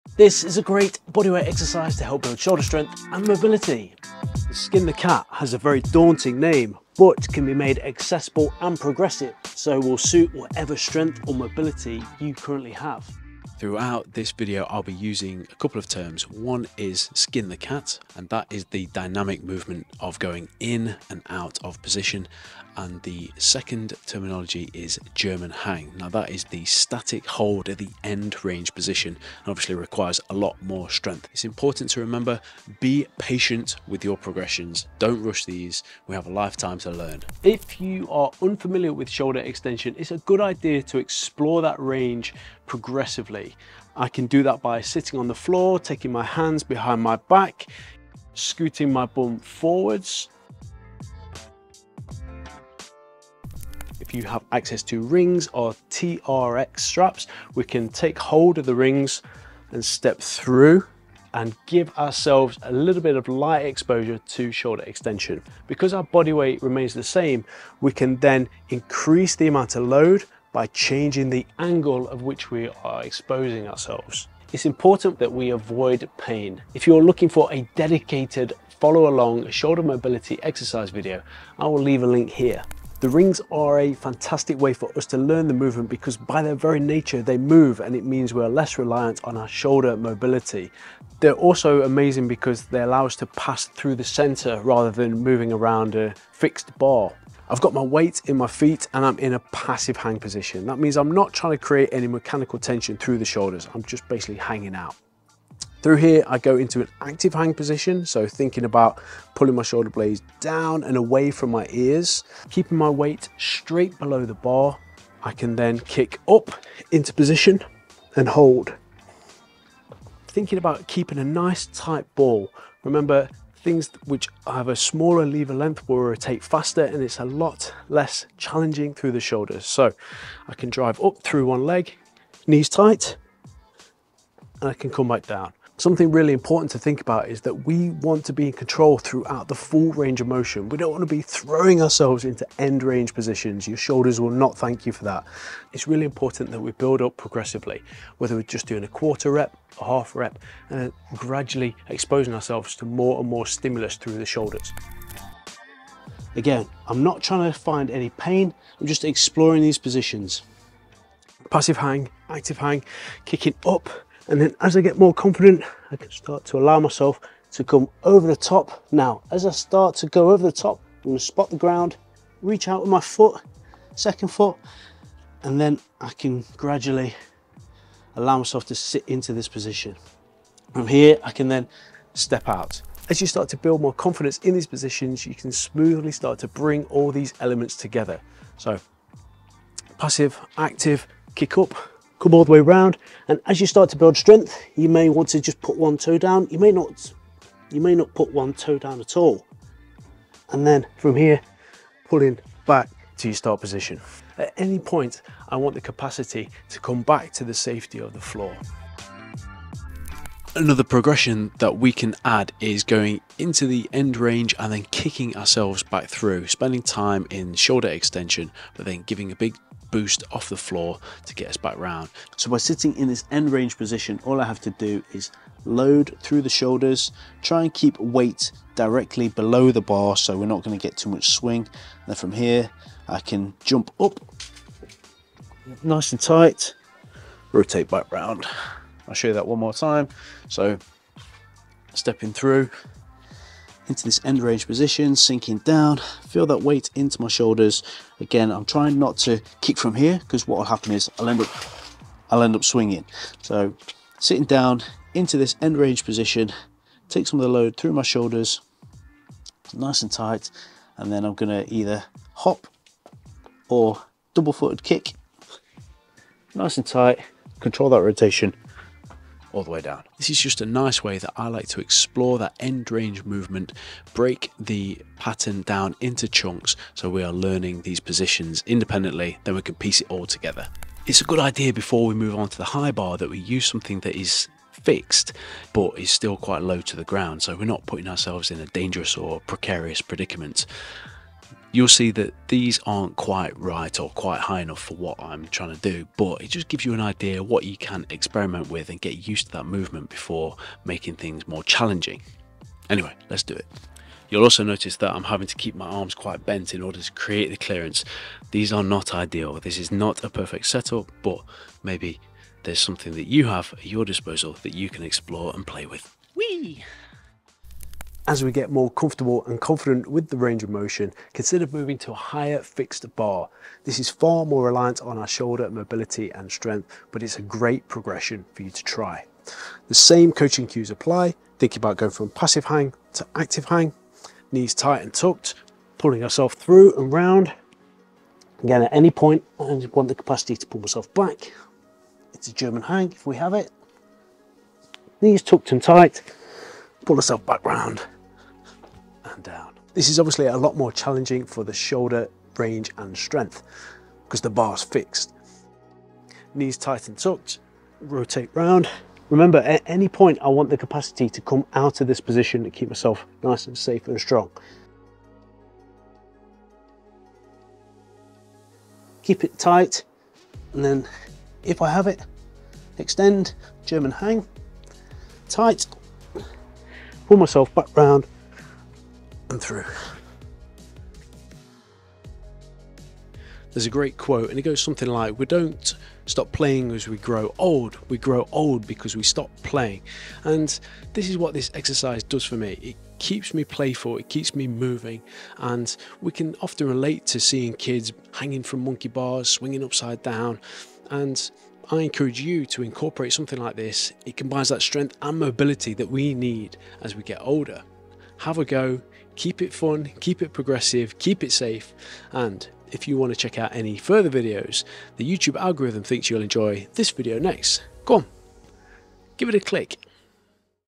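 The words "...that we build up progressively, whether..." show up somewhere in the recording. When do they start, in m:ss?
2:26.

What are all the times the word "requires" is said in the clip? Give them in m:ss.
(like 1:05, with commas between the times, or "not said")
0:29.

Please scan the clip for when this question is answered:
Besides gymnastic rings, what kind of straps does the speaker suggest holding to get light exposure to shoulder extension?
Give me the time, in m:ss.
0:55.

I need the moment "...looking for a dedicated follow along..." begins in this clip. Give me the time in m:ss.
1:17.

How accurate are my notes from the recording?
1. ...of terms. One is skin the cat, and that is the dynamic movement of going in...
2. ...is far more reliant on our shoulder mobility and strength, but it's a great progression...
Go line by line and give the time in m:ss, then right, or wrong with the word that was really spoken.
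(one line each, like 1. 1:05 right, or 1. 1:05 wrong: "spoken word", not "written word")
1. 0:15 right
2. 5:23 right.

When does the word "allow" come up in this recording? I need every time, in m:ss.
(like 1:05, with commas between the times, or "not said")
1:32, 2:46, 2:58.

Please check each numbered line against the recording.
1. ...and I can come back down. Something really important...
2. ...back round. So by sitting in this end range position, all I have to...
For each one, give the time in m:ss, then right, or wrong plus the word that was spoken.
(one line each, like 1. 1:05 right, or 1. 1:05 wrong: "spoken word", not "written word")
1. 2:14 right
2. 3:41 right.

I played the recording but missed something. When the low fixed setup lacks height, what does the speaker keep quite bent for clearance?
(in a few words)
Arms.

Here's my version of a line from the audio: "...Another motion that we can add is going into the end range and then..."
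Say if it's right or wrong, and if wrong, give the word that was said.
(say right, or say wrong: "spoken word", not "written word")
wrong: "progression", not "motion".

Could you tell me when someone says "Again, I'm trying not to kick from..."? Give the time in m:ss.
4:08.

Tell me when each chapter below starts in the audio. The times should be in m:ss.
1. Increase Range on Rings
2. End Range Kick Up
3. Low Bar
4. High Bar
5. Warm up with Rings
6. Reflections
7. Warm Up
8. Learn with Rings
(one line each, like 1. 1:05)
1. 2:34
2. 3:30
3. 4:40
4. 5:17
5. 0:53
6. 6:22
7. 0:37
8. 1:22.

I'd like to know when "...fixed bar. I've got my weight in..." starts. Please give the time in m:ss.
1:36.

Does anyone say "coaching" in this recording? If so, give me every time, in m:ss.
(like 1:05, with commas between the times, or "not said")
5:30.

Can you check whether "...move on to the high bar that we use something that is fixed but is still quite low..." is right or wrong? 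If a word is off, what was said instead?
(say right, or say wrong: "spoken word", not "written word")
right.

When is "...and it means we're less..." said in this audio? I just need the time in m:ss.
1:27.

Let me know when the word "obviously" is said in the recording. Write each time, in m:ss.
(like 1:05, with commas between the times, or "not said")
0:29, 5:50.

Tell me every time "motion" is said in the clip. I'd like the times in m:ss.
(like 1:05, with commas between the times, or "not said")
2:20, 5:20.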